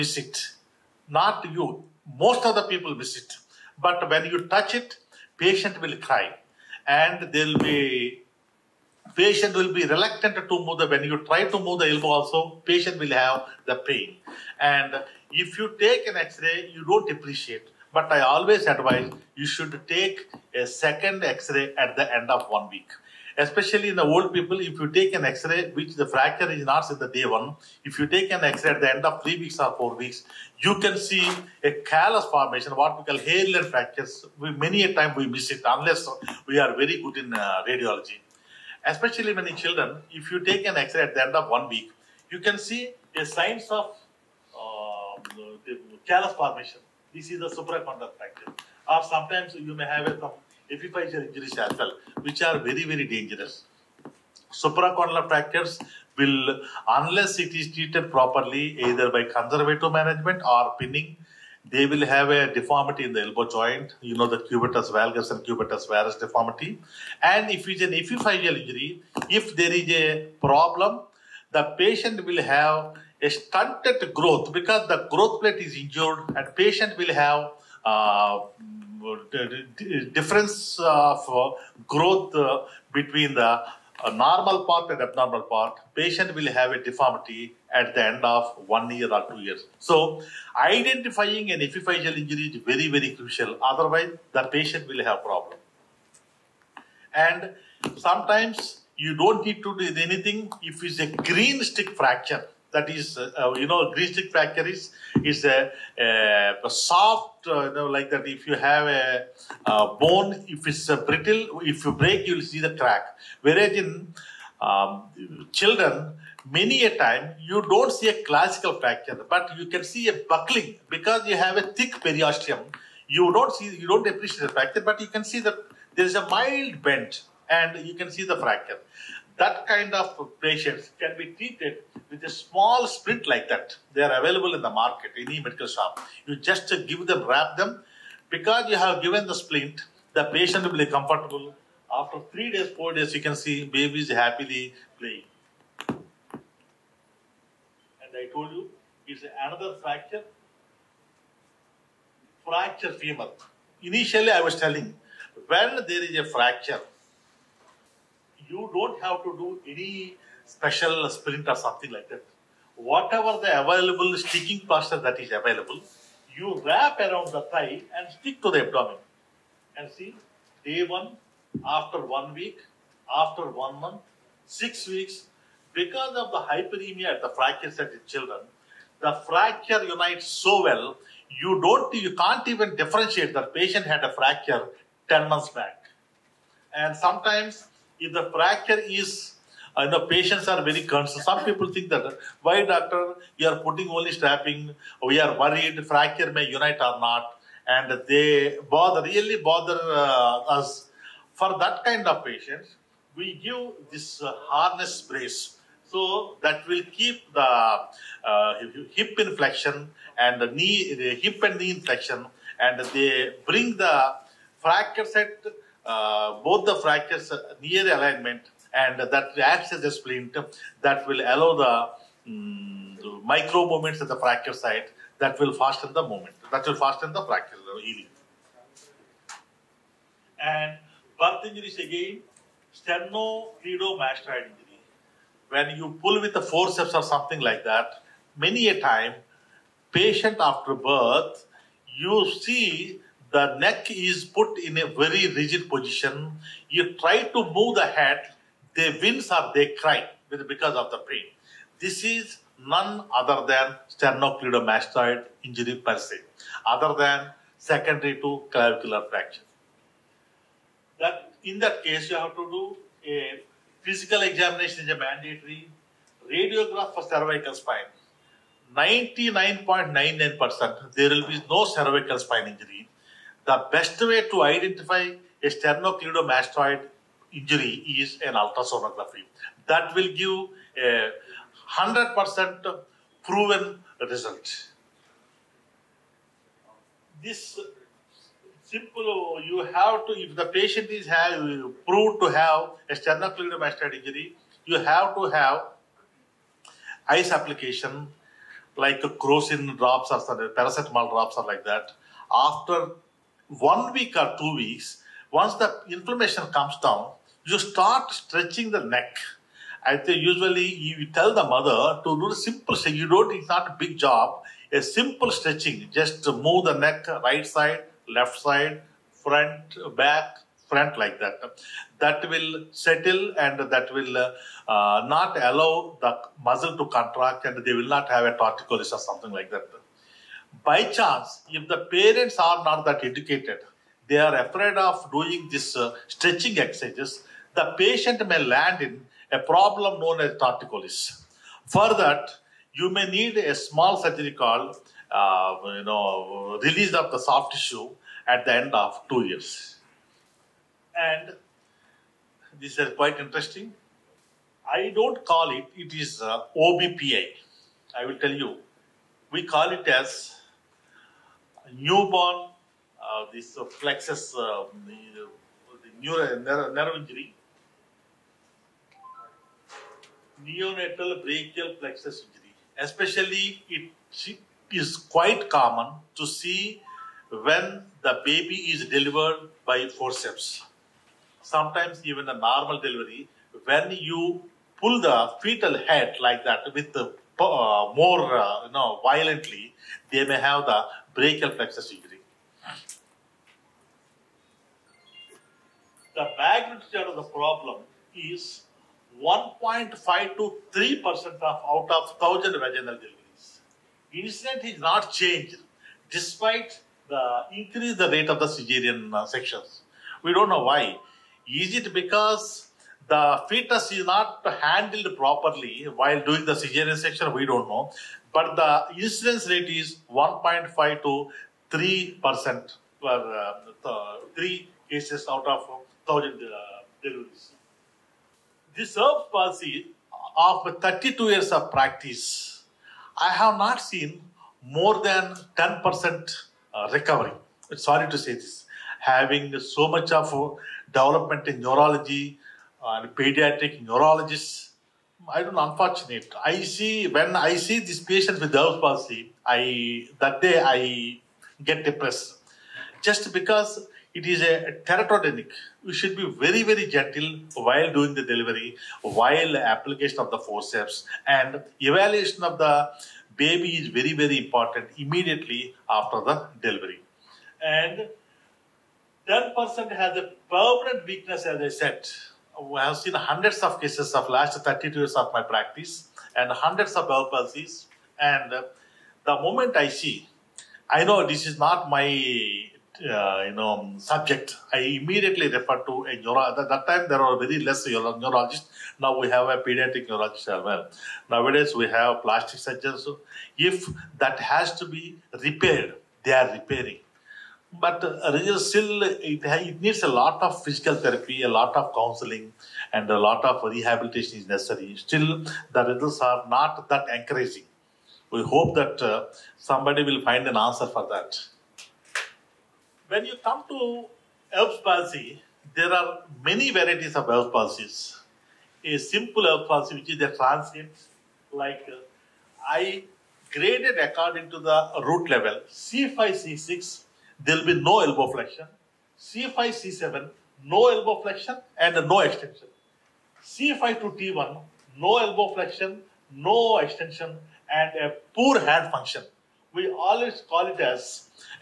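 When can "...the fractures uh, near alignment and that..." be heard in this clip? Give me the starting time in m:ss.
3:36.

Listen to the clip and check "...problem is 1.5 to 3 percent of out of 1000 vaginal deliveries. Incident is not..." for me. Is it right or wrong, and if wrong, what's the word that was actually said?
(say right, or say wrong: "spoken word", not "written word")
right.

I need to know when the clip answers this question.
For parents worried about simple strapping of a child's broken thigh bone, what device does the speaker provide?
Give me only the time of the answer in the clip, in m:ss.
3:24.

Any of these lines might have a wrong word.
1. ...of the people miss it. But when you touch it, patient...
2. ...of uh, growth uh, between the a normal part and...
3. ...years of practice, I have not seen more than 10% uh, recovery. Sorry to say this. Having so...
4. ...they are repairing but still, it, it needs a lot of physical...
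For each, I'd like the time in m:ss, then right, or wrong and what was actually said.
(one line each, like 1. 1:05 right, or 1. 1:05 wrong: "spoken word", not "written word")
1. 0:02 right
2. 1:20 right
3. 7:11 right
4. 8:16 right.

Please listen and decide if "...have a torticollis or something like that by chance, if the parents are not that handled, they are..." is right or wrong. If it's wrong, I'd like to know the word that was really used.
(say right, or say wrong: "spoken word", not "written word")
wrong: "educated", not "handled".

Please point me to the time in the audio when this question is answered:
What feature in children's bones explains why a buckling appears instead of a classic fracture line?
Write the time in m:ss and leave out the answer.
2:01.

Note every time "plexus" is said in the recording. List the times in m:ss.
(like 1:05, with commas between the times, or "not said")
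6:03, 6:11, 6:31.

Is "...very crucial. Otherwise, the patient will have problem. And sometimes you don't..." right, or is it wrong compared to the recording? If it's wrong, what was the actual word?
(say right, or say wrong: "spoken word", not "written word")
right.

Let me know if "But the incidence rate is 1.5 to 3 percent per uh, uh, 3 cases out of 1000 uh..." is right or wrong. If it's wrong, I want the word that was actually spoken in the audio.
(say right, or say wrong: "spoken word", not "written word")
right.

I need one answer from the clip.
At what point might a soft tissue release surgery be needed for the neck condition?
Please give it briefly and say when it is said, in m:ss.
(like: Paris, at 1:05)
end of 2 years, at 5:48.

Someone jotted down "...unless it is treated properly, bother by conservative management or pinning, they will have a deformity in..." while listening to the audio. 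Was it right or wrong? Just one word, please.
wrong.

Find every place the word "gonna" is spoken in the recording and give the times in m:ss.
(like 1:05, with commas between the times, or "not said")
not said.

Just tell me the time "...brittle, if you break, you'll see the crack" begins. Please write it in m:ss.
1:51.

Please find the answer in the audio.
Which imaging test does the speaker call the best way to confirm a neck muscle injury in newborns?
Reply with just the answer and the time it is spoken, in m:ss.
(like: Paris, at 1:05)
ultrasonography, at 4:38.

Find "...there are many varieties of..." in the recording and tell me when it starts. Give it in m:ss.
8:35.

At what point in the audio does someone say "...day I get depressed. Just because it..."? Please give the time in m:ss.
7:30.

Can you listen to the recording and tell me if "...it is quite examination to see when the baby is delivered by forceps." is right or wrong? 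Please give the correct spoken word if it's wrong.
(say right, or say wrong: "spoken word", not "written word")
wrong: "common", not "examination".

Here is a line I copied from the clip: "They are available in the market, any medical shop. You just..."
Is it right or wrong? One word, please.
right.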